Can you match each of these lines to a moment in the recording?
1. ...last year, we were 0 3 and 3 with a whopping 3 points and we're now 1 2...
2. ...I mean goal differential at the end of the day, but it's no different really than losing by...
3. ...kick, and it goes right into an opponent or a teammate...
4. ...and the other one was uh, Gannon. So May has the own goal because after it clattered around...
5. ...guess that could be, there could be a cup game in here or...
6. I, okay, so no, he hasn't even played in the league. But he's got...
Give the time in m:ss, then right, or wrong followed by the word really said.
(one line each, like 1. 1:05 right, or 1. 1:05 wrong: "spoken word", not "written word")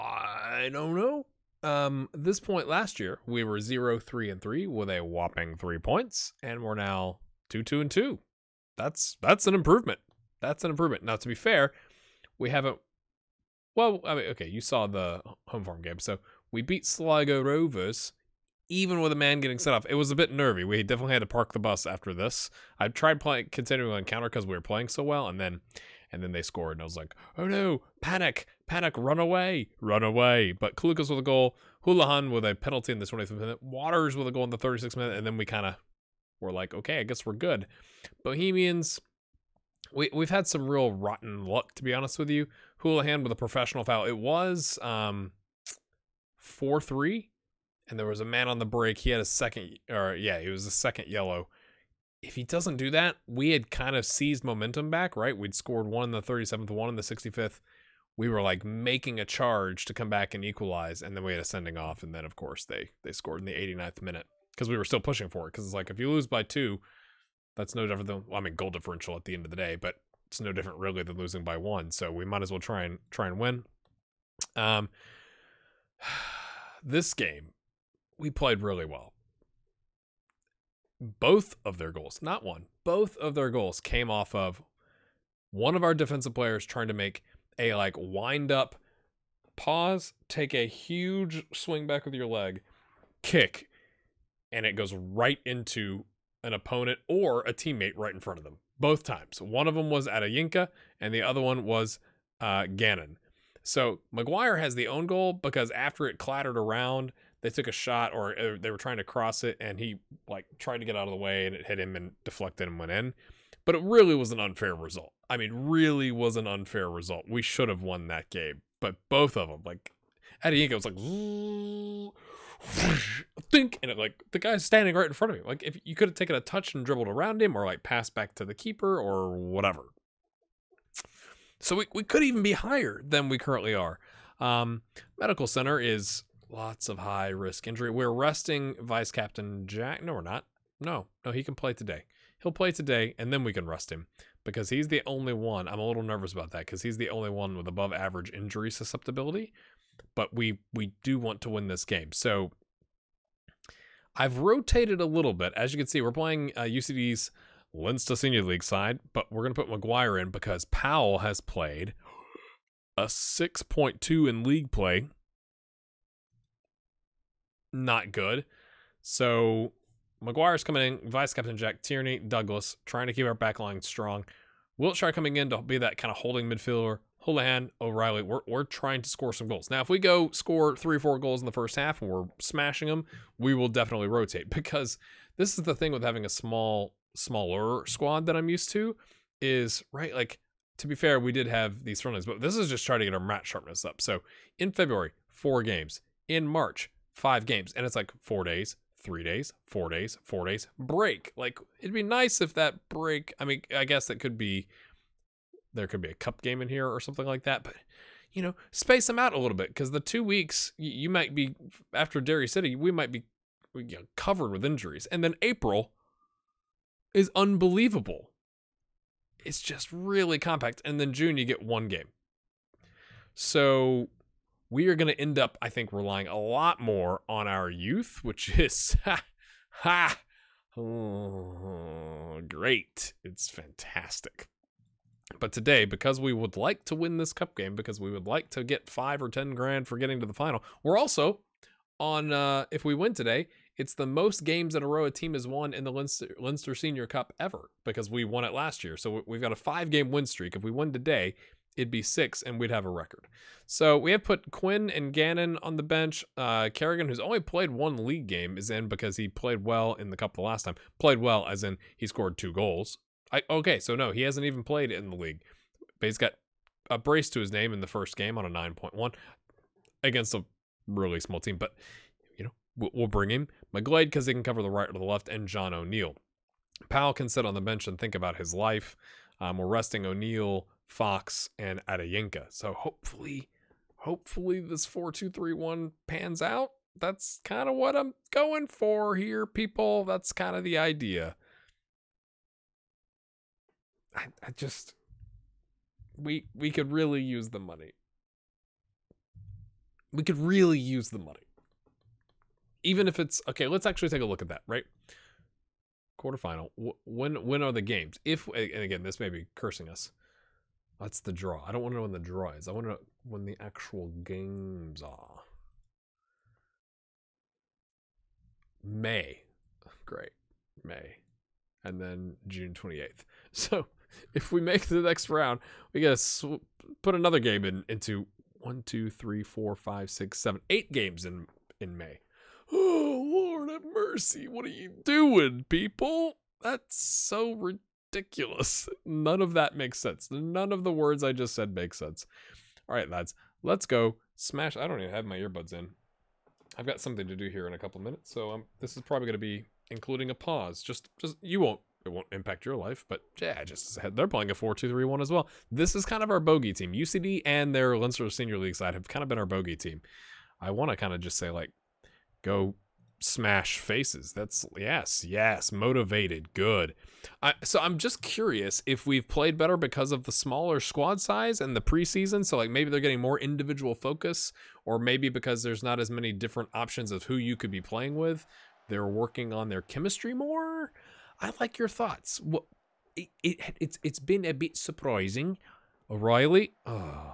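1. 0:02 wrong: "2", not "1"
2. 1:08 right
3. 1:33 right
4. 1:41 wrong: "McGuire", not "May"
5. 3:23 right
6. 4:23 right.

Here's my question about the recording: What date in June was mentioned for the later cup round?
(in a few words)
June 28th.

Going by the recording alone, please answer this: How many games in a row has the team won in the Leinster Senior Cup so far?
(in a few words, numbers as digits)
5.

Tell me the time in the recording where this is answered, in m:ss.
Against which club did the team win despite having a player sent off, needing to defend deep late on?
0:16.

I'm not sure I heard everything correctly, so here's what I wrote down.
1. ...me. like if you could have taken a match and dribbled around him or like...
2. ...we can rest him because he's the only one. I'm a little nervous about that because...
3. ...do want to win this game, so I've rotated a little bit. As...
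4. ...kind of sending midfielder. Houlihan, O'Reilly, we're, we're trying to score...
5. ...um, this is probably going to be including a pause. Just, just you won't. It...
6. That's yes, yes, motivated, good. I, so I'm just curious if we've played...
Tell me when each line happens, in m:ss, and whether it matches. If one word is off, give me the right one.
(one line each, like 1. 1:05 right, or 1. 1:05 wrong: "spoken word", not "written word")
1. 2:05 wrong: "touch", not "match"
2. 2:23 right
3. 2:31 right
4. 2:55 wrong: "holding", not "sending"
5. 5:48 right
6. 6:04 right.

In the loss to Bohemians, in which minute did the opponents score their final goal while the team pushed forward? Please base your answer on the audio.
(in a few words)
89th.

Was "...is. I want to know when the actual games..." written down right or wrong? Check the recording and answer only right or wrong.
right.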